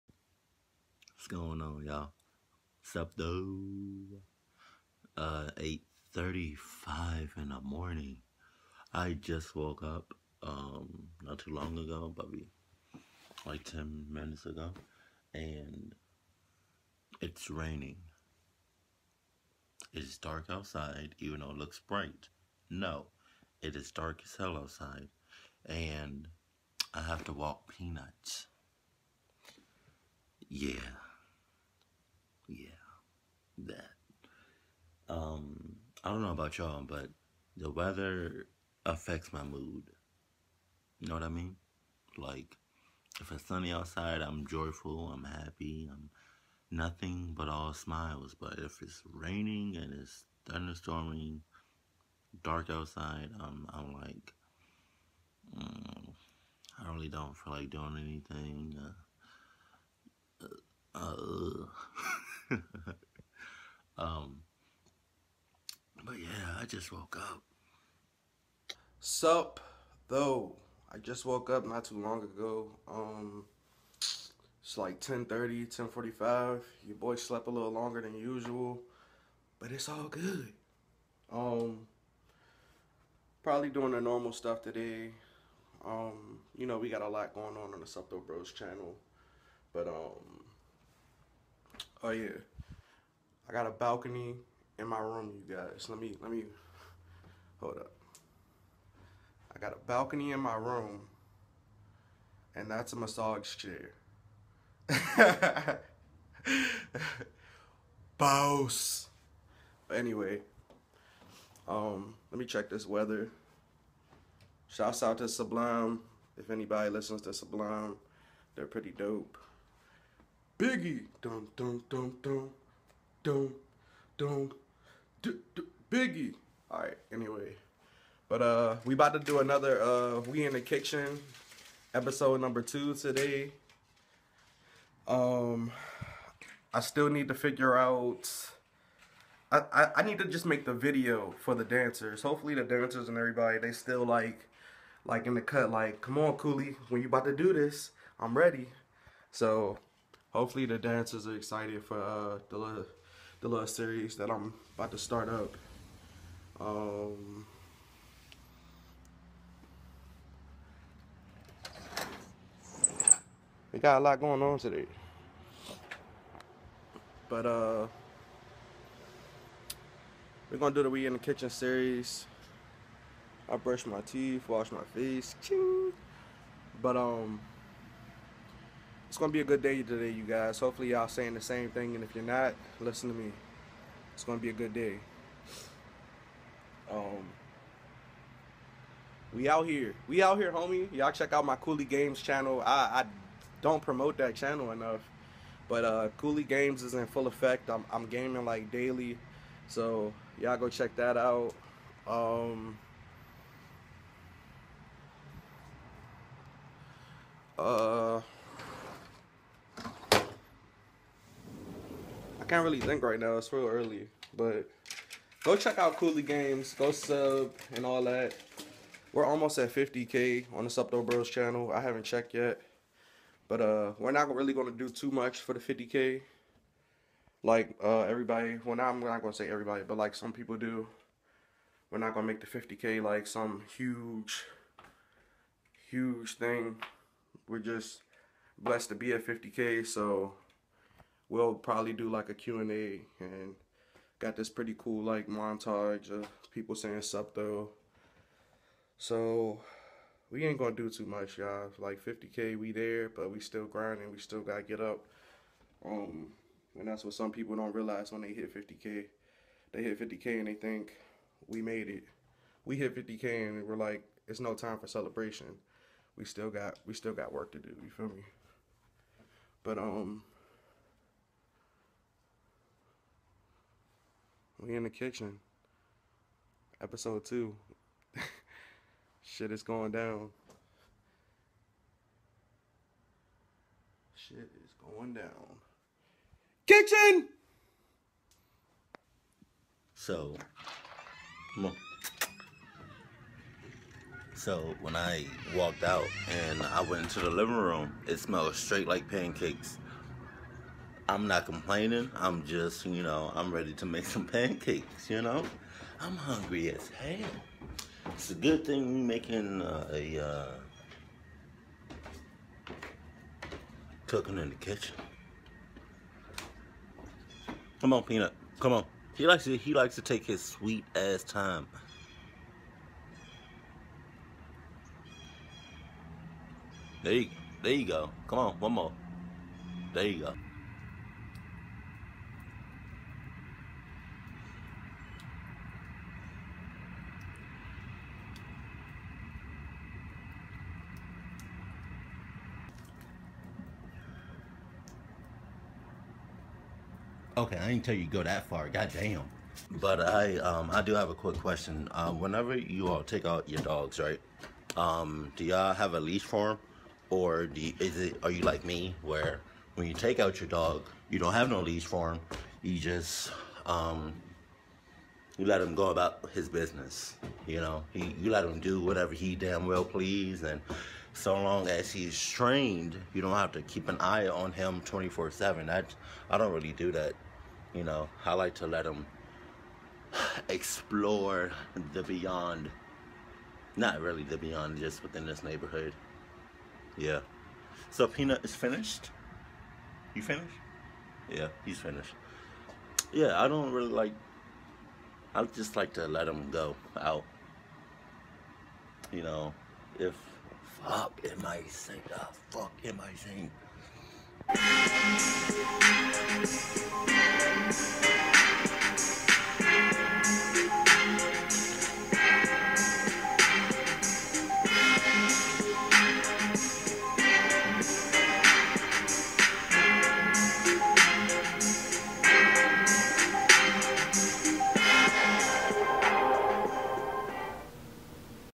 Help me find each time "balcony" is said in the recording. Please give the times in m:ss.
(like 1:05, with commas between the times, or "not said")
1:33, 1:39.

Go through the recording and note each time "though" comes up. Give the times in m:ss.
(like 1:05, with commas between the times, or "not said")
0:03, 0:21, 1:10, 4:07.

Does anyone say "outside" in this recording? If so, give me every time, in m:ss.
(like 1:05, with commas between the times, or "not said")
0:20, 0:24, 0:43, 0:52.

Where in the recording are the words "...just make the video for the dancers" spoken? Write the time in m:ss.
2:20.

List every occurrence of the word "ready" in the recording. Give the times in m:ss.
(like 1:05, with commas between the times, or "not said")
2:28, 5:03.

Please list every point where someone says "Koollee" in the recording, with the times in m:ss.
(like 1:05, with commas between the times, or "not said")
2:26, 3:11, 3:16, 3:35.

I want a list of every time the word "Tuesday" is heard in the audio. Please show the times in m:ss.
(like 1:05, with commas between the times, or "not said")
not said.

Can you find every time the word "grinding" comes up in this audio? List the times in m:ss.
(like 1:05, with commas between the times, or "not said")
4:13.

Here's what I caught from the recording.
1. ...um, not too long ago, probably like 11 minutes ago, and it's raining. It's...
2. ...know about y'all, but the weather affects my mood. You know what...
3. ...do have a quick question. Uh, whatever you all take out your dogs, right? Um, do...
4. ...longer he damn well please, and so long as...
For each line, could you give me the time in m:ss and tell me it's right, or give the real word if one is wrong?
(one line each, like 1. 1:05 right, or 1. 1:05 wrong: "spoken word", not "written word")
1. 0:10 wrong: "10", not "11"
2. 0:36 right
3. 5:50 wrong: "whenever", not "whatever"
4. 6:08 wrong: "whatever", not "longer".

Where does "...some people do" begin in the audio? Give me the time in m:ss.
3:50.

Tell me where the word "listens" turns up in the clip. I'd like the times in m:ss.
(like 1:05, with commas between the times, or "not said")
1:56, 3:02.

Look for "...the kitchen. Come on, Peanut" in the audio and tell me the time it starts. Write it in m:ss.
5:14.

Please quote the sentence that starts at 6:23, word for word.
Not really the beyond, just within this neighborhood.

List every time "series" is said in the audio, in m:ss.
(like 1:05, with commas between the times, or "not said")
2:33, 2:51.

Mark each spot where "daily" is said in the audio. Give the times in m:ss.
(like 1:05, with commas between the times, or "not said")
3:18.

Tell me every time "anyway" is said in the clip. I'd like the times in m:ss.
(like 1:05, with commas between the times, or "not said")
1:49, 2:07.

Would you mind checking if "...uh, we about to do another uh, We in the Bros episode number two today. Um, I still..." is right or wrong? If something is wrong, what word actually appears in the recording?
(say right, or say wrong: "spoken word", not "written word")
wrong: "Kitchen", not "Bros".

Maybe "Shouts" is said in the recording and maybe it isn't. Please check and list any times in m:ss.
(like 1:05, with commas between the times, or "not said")
1:54.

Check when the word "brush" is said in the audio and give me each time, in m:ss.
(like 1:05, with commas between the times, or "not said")
2:53.